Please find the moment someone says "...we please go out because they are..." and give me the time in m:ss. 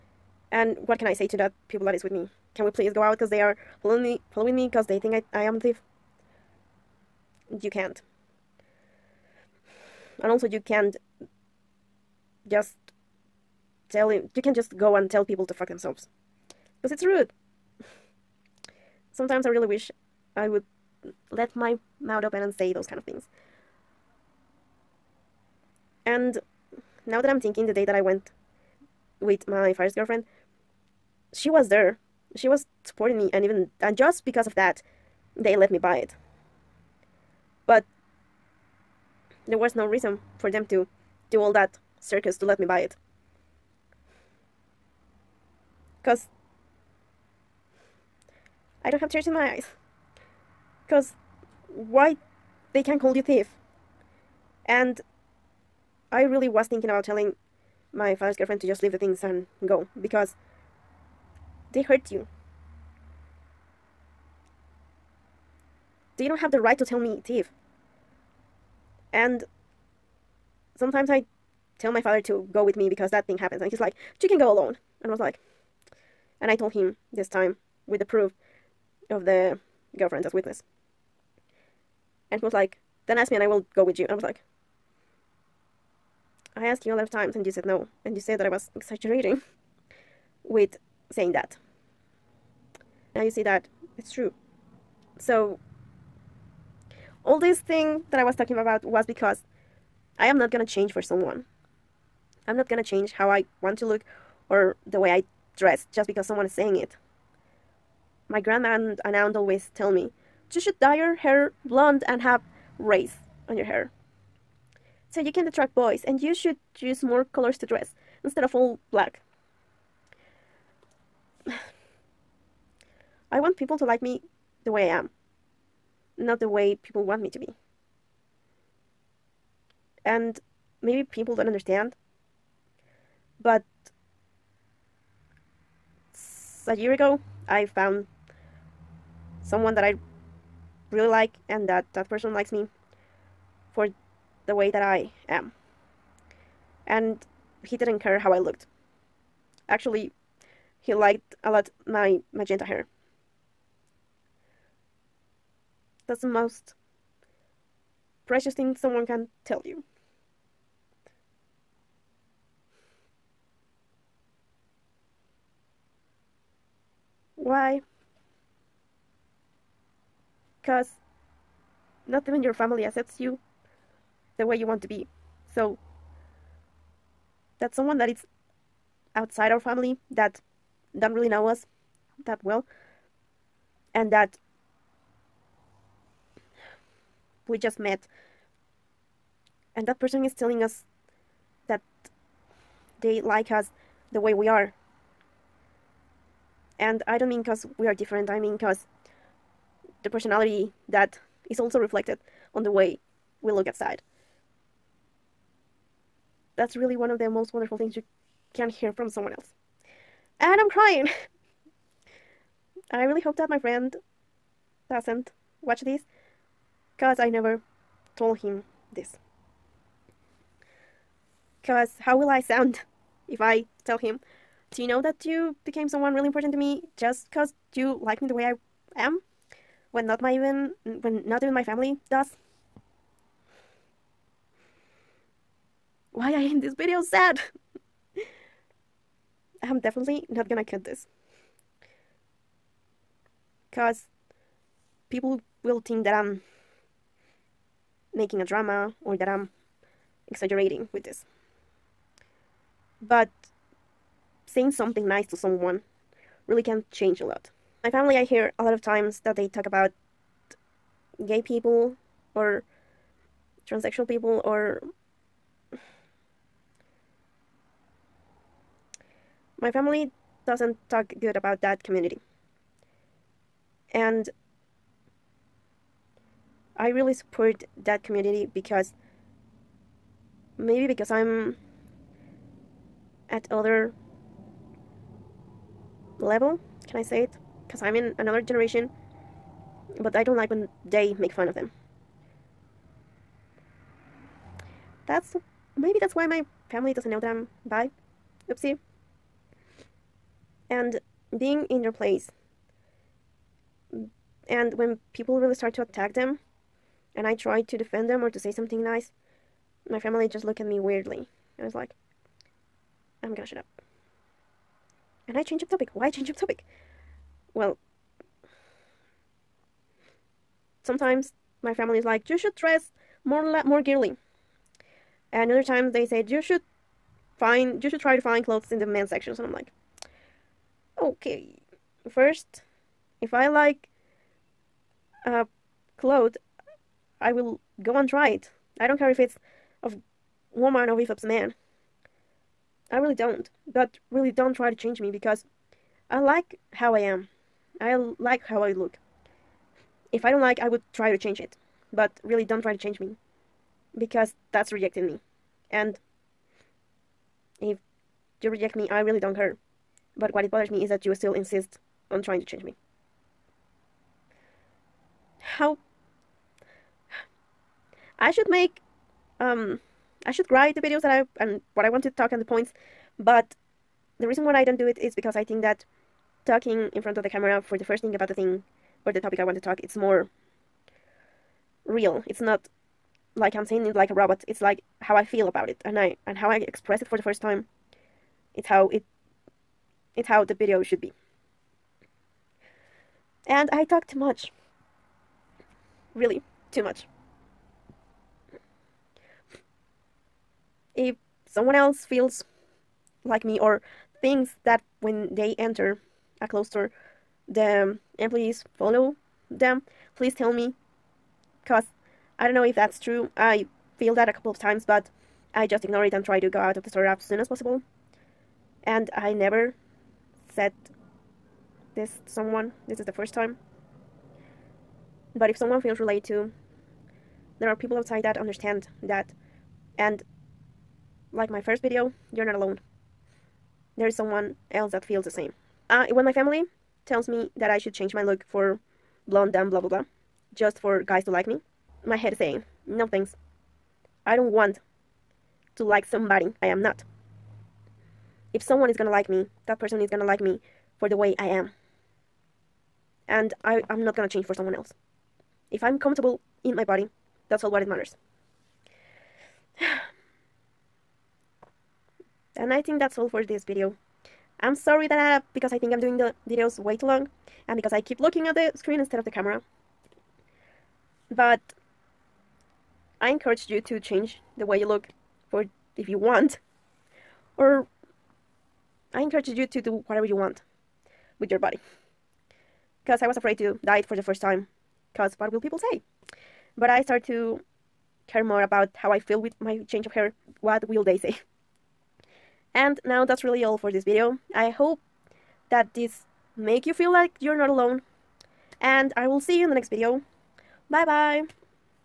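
0:02.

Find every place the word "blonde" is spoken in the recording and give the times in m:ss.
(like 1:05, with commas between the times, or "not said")
1:51, 7:19.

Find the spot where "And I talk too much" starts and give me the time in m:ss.
6:33.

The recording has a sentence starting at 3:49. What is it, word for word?
When not my even when not even my family does?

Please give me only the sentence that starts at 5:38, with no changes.
I don't care if it's of woman or if it's man.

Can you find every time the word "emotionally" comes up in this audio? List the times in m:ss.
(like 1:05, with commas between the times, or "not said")
not said.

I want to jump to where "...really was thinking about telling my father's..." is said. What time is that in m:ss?
0:56.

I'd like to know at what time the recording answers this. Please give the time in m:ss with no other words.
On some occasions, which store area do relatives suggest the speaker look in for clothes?
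5:28.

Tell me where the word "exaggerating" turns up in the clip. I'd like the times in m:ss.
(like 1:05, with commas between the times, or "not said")
1:28, 4:10.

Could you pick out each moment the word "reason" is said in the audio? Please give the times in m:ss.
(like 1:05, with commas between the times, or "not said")
0:39, 6:14.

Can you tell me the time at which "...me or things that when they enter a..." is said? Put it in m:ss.
6:43.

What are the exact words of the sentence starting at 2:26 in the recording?
And he didn't care how I looked.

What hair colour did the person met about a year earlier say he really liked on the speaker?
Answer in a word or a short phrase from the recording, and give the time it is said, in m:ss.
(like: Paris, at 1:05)
magenta, at 2:32.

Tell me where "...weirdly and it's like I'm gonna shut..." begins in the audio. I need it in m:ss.
5:10.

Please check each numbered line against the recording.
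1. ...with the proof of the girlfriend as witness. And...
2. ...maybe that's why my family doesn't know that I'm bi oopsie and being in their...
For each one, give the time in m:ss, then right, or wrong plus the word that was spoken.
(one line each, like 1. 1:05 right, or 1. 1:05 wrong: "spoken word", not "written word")
1. 1:17 right
2. 4:55 right.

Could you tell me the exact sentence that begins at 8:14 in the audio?
I hope that this make you feel like you're not alone.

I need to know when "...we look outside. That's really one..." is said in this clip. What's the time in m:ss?
3:23.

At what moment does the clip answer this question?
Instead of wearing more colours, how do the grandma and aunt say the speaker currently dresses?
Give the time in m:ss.
1:58.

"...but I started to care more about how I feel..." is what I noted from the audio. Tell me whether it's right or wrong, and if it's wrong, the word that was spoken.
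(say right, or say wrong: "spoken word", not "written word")
right.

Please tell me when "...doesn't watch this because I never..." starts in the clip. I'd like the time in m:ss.
3:34.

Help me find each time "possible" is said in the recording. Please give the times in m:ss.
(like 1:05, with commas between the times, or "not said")
6:57.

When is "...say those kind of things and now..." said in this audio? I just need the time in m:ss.
0:22.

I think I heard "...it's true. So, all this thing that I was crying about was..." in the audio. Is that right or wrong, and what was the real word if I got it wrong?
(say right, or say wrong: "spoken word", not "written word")
wrong: "talking", not "crying".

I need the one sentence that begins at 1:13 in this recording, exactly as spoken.
And he's like, you can go alone.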